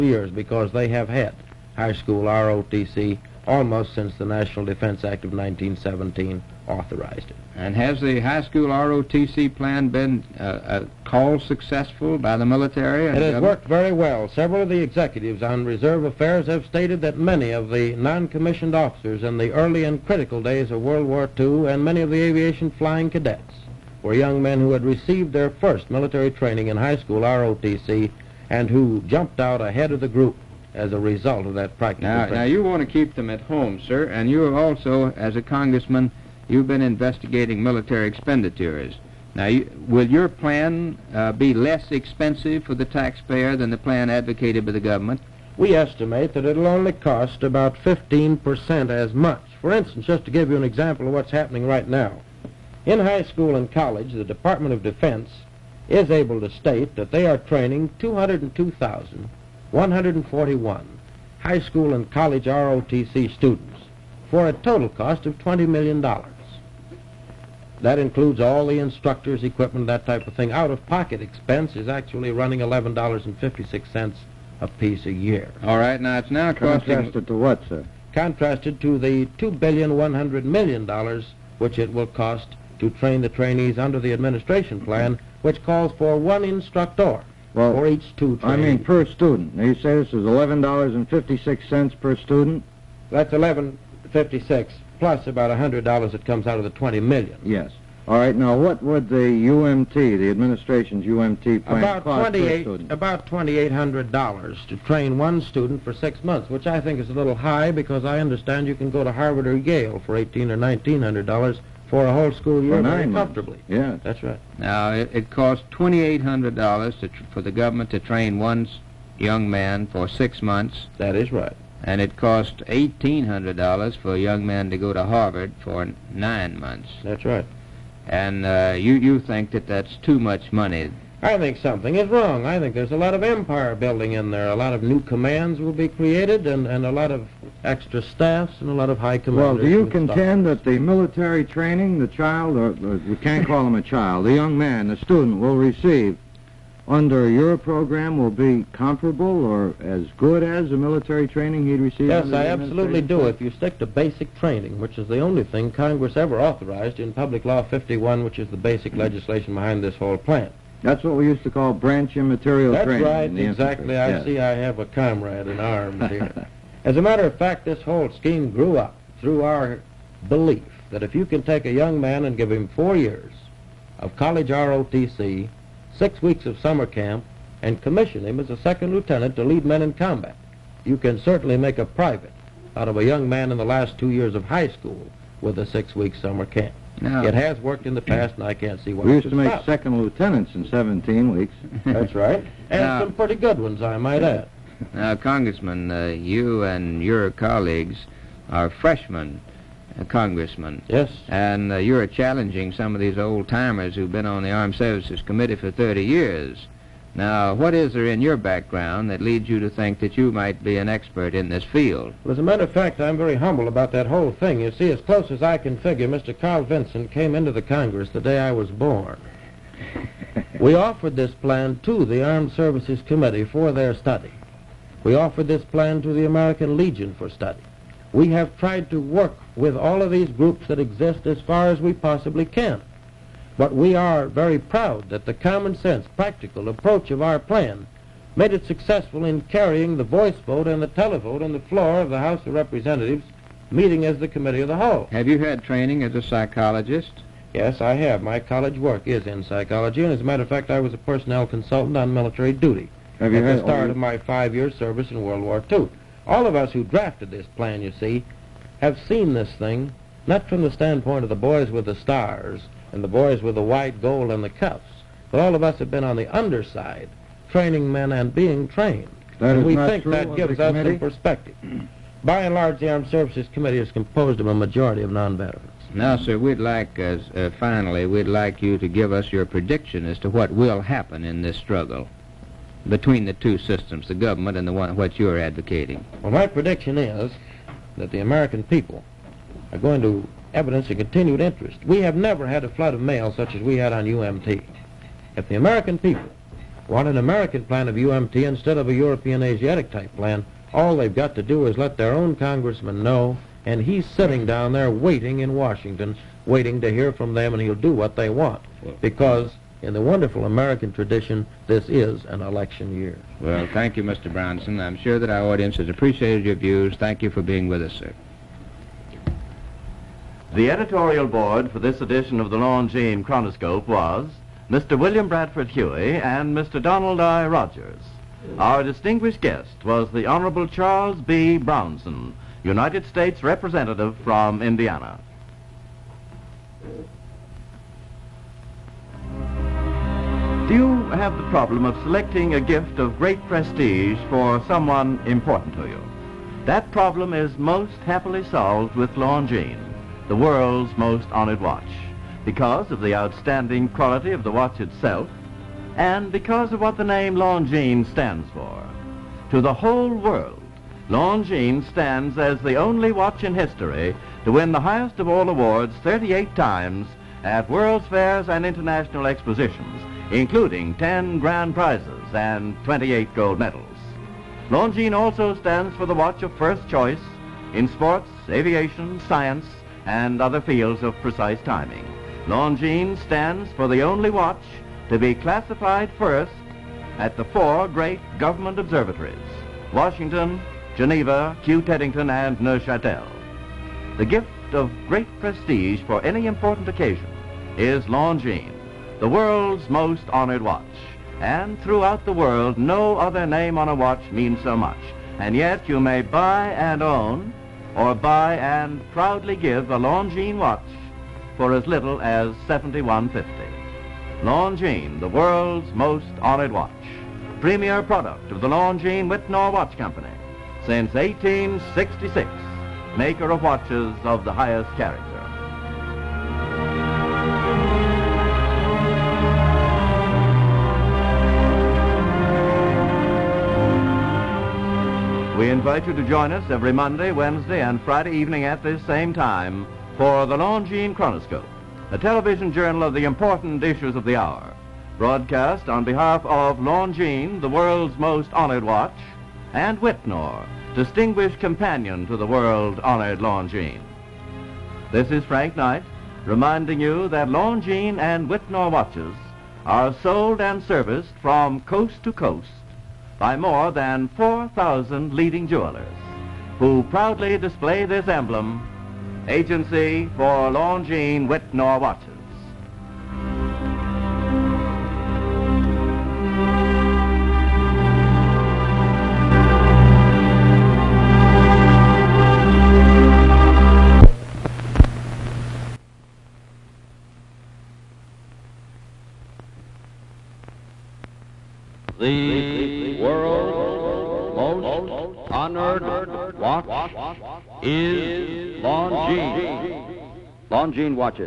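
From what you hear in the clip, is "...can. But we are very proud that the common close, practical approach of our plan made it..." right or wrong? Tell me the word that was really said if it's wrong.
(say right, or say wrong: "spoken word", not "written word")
wrong: "sense", not "close".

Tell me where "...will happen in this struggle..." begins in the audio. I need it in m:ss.
4:40.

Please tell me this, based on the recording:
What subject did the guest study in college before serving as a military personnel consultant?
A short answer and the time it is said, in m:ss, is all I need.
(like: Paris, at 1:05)
psychology, at 4:09.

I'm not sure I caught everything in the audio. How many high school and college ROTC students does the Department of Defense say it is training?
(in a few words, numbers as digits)
202,141.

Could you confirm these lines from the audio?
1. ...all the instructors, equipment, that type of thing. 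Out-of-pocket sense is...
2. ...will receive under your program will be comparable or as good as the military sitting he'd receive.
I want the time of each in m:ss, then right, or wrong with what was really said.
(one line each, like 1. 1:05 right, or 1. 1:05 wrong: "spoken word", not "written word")
1. 1:08 wrong: "expense", not "sense"
2. 2:25 wrong: "training", not "sitting".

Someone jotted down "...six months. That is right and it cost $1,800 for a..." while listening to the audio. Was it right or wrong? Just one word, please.
right.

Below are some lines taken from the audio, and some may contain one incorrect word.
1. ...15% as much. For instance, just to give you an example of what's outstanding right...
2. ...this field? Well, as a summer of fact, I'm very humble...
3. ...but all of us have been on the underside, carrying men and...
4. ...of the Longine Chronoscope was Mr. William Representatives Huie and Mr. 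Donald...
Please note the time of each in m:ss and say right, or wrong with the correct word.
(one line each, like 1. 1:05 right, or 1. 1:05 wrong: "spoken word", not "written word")
1. 0:47 wrong: "happening", not "outstanding"
2. 3:31 wrong: "matter", not "summer"
3. 4:25 wrong: "training", not "carrying"
4. 5:22 wrong: "Bradford", not "Representatives".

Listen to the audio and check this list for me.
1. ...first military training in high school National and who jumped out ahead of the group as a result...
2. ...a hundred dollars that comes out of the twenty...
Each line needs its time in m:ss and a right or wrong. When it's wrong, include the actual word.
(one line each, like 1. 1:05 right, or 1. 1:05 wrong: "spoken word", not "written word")
1. 0:25 wrong: "ROTC", not "National"
2. 1:35 right.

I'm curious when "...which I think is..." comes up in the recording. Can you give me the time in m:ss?
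1:46.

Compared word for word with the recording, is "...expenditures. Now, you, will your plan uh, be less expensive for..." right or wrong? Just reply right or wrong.
right.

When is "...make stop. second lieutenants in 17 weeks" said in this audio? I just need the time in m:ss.
3:09.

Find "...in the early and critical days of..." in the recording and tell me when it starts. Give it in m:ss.
0:19.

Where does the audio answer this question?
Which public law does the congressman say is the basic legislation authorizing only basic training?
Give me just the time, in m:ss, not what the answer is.
2:37.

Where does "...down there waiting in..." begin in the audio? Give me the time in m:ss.
5:04.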